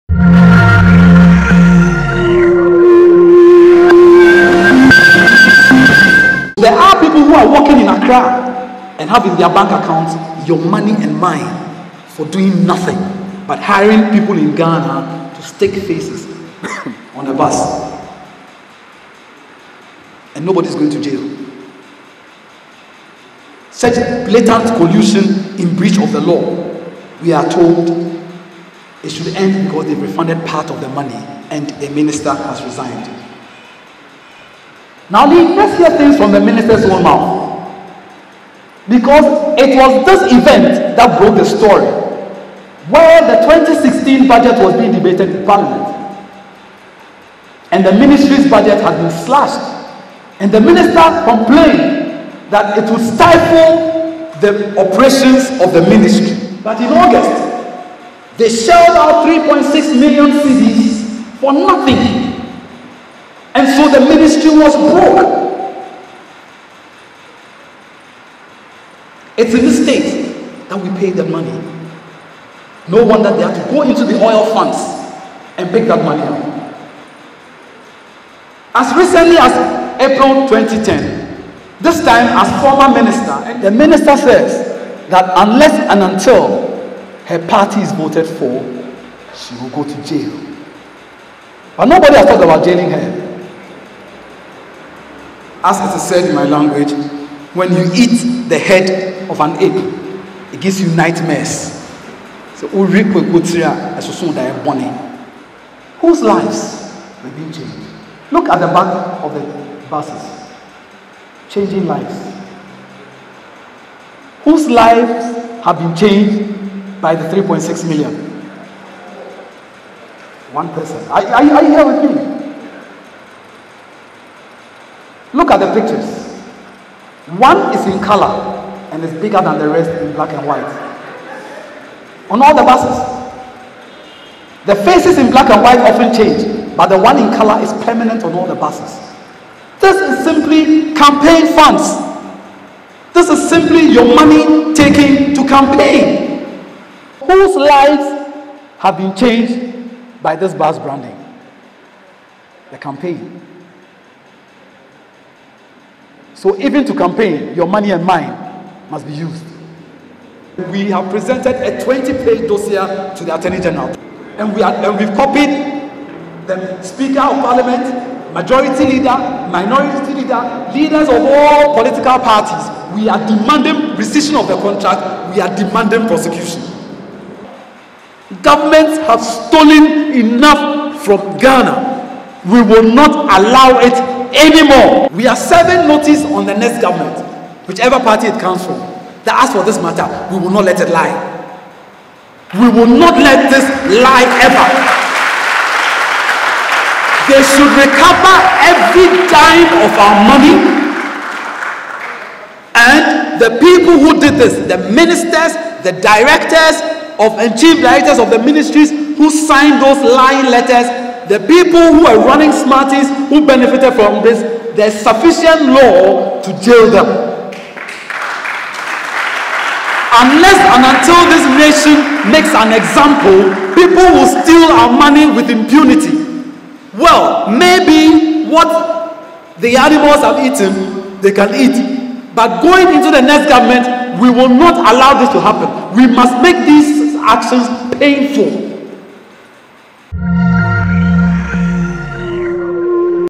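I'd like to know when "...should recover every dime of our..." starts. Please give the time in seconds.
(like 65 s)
197 s.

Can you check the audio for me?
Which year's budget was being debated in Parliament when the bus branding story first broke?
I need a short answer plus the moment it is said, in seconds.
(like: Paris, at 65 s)
2016, at 43 s.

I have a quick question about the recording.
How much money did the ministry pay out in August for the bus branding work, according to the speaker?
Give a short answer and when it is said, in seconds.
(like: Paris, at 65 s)
3.6 million cedis, at 59 s.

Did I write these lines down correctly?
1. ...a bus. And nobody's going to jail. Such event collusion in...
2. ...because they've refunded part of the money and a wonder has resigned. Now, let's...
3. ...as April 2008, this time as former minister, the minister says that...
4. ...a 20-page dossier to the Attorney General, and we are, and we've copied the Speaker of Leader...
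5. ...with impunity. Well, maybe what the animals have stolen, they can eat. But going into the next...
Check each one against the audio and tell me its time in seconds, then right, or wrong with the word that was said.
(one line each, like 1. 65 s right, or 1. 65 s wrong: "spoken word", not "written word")
1. 17 s wrong: "blatant", not "event"
2. 29 s wrong: "minister", not "wonder"
3. 79 s wrong: "2010", not "2008"
4. 161 s wrong: "Parliament", not "Leader"
5. 225 s wrong: "eaten", not "stolen".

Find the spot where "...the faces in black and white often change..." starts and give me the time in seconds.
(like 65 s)
134 s.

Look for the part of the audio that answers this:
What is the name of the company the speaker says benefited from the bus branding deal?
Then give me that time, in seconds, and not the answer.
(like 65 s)
212 s.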